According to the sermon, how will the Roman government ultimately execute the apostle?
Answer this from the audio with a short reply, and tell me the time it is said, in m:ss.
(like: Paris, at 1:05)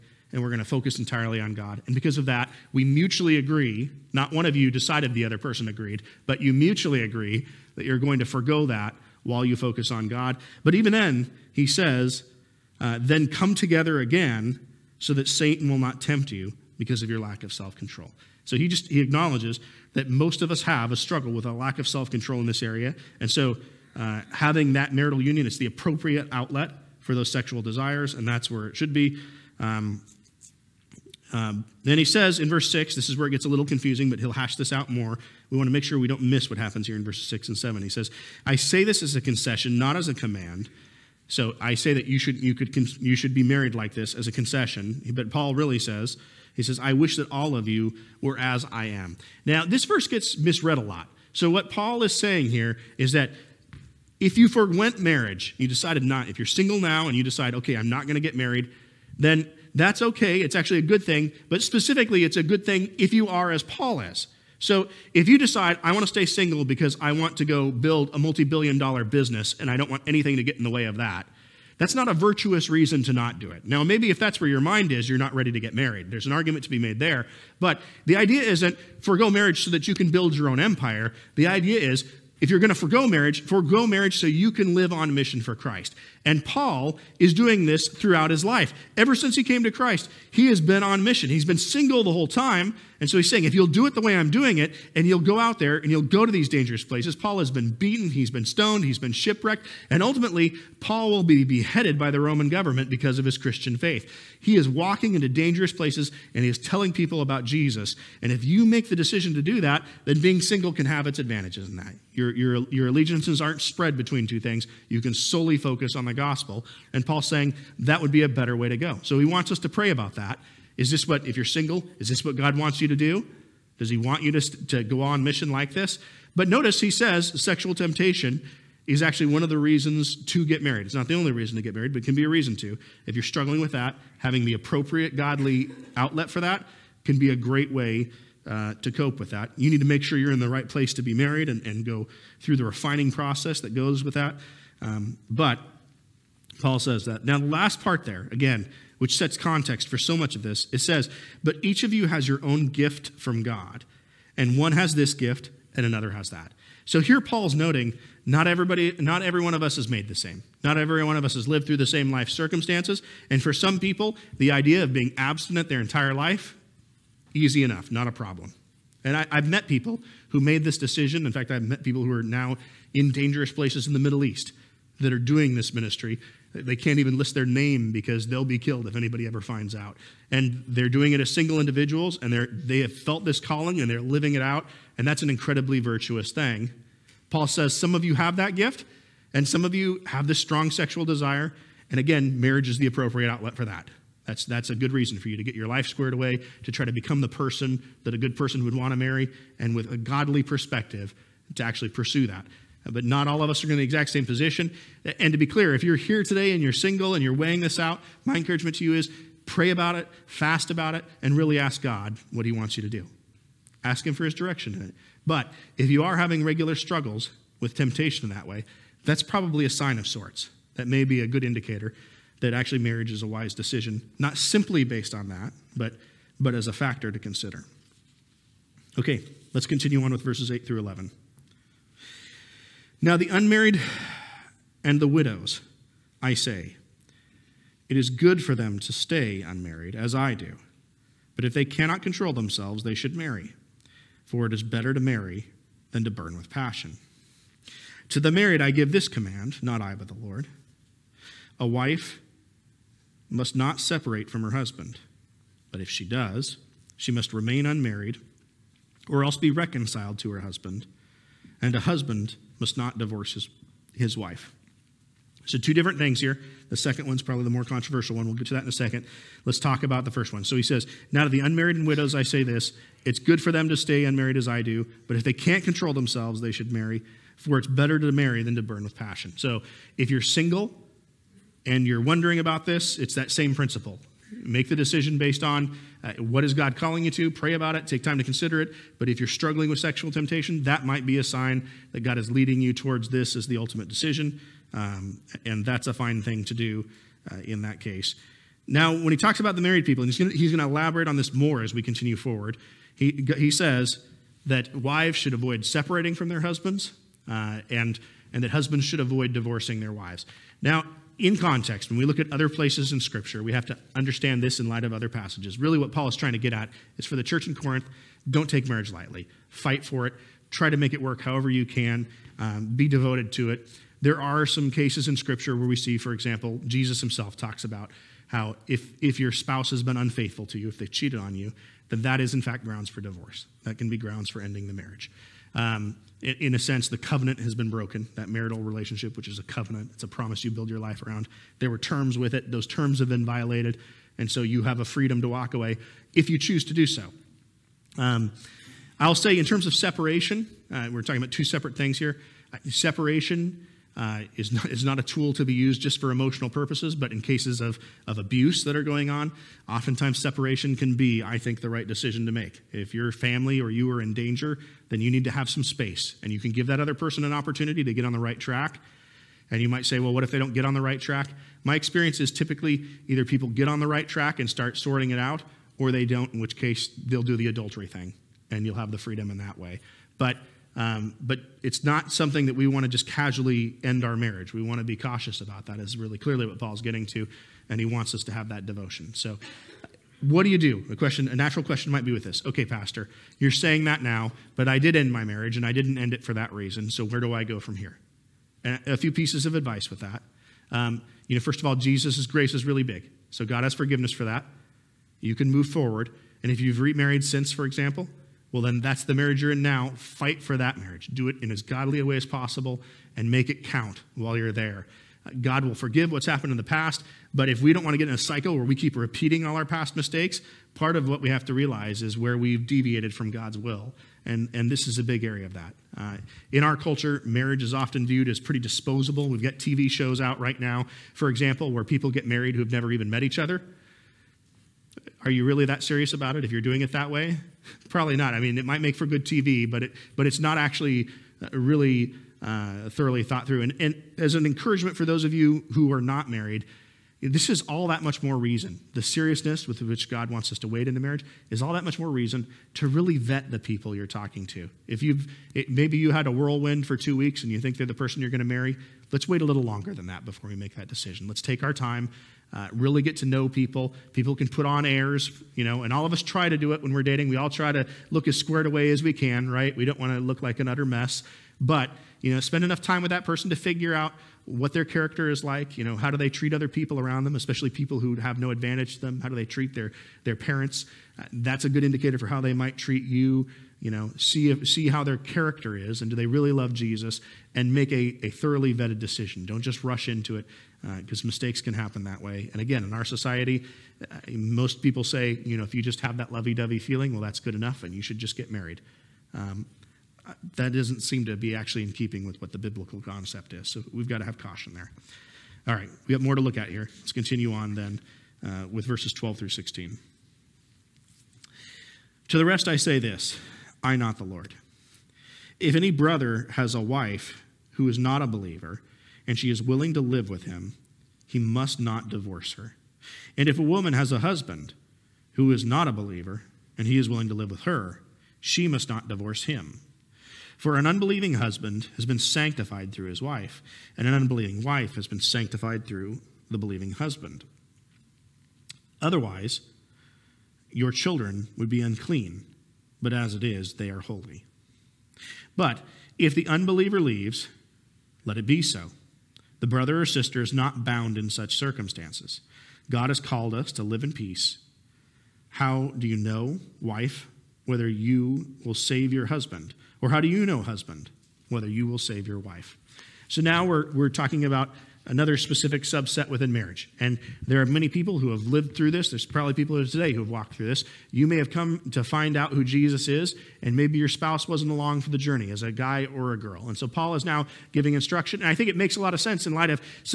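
beheaded, at 1:41.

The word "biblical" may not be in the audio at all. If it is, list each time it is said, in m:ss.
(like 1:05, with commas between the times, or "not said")
8:22.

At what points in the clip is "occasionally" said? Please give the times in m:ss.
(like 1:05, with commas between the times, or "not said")
not said.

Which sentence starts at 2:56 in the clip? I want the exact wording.
They can't even list their name because they'll be killed if anybody ever finds out.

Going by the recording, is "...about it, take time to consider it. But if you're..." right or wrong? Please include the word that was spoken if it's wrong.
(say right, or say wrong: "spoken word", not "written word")
right.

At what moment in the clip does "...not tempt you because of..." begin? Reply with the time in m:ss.
0:15.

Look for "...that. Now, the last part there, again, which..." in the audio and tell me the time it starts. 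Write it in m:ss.
2:27.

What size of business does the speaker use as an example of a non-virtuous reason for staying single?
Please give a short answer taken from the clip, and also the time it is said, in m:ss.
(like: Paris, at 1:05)
multi billion dollar, at 1:08.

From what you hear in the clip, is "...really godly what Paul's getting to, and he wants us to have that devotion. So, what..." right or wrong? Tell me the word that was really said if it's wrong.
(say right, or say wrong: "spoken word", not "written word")
wrong: "clearly", not "godly".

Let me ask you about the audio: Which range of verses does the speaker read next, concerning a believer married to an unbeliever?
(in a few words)
12 through 16.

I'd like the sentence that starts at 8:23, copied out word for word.
So we've got to have caution there.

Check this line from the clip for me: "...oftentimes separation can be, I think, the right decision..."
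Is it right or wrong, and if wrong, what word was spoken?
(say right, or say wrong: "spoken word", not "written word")
right.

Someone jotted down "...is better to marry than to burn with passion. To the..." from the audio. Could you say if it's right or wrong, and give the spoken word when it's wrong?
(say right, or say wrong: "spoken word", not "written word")
right.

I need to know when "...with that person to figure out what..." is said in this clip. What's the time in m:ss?
7:53.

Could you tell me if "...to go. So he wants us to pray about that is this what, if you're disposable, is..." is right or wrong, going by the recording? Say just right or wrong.
wrong.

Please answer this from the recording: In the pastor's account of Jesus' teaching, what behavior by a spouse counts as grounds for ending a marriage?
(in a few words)
unfaithful.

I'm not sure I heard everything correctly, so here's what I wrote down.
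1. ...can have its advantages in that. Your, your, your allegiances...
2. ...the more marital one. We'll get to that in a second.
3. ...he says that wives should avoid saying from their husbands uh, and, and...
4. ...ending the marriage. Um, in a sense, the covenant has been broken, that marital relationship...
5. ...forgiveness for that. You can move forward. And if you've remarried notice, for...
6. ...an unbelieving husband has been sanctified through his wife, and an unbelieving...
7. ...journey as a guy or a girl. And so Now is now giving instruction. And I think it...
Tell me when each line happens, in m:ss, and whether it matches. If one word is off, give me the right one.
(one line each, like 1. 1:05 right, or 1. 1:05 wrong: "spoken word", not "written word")
1. 1:50 right
2. 4:27 wrong: "controversial", not "marital"
3. 5:03 wrong: "separating", not "saying"
4. 5:34 right
5. 6:43 wrong: "since", not "notice"
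6. 8:50 right
7. 9:35 wrong: "Paul", not "Now".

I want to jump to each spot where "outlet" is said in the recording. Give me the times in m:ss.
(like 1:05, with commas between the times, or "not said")
0:26, 2:15, 3:13.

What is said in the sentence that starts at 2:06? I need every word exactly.
But notice he says sexual temptation is actually one of the reasons to get married.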